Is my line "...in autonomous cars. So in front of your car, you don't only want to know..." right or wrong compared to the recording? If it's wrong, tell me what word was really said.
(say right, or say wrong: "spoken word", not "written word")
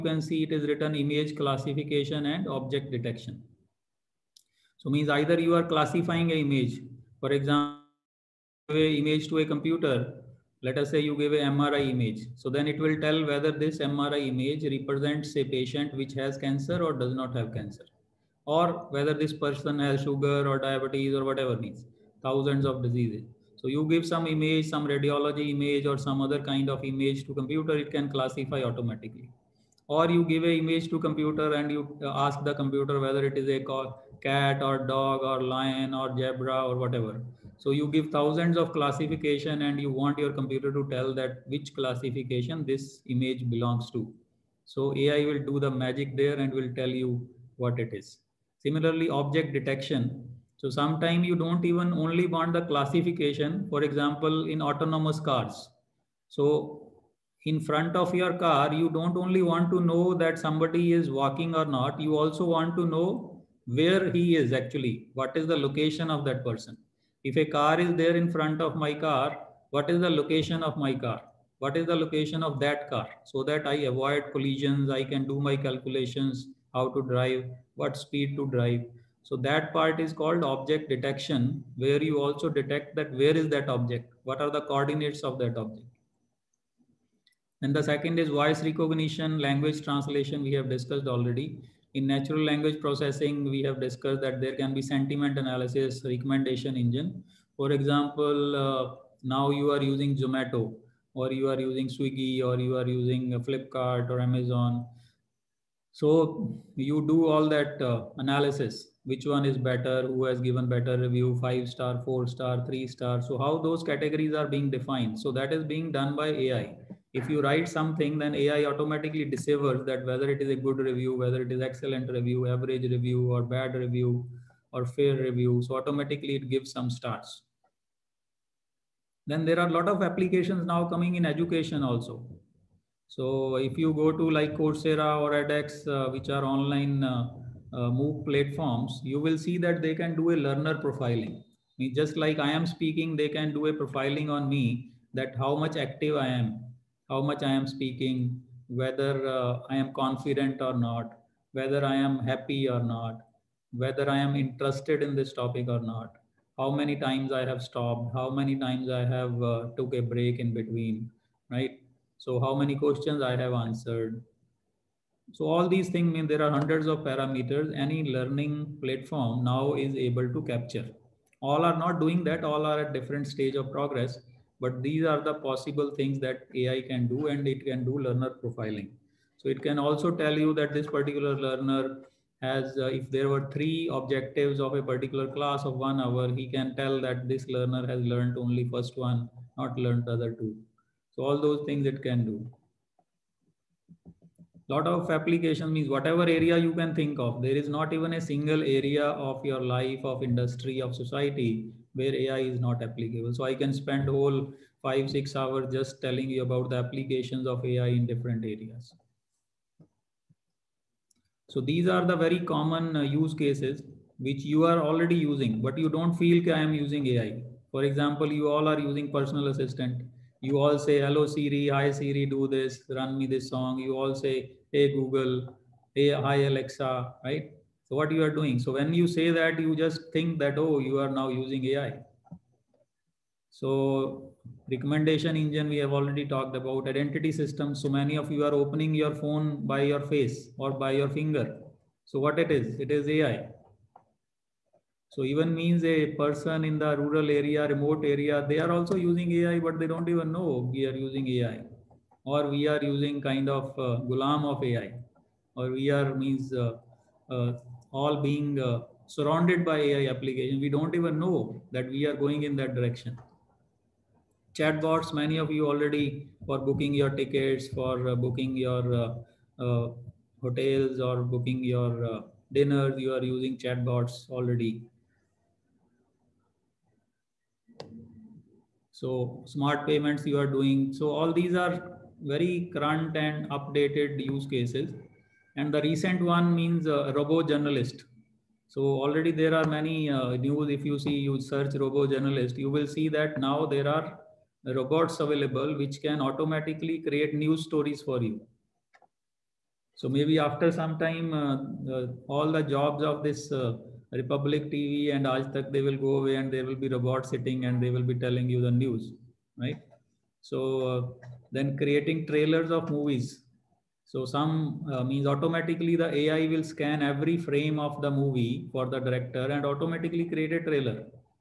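right.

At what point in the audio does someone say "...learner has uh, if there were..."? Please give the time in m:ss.
3:01.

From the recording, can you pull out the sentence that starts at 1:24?
What are the coordinates of that object?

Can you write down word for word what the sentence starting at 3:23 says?
So I can spend whole five, six hours just telling you about the applications of AI in different areas.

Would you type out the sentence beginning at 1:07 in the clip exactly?
If a car is there in front of my car, what is the location of my car?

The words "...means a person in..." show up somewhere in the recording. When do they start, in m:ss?
4:05.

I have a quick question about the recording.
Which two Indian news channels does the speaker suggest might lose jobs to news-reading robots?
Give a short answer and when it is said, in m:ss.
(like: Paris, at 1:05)
Republic TV and Aaj Tak, at 5:04.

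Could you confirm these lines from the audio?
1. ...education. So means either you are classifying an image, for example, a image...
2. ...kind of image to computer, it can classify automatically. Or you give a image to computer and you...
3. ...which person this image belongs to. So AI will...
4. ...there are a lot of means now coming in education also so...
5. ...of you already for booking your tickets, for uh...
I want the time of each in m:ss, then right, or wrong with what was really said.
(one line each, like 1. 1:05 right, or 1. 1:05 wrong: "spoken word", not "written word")
1. 0:02 wrong: "detection", not "education"
2. 0:26 right
3. 0:41 wrong: "classification", not "person"
4. 2:09 wrong: "applications", not "means"
5. 4:25 right.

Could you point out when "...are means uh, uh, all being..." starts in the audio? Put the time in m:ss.
4:15.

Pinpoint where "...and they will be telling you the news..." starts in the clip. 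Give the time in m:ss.
5:07.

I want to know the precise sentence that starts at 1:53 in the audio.
So how those categories are being defined.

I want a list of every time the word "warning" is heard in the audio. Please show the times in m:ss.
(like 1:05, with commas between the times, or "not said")
not said.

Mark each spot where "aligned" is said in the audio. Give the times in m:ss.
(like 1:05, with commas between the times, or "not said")
not said.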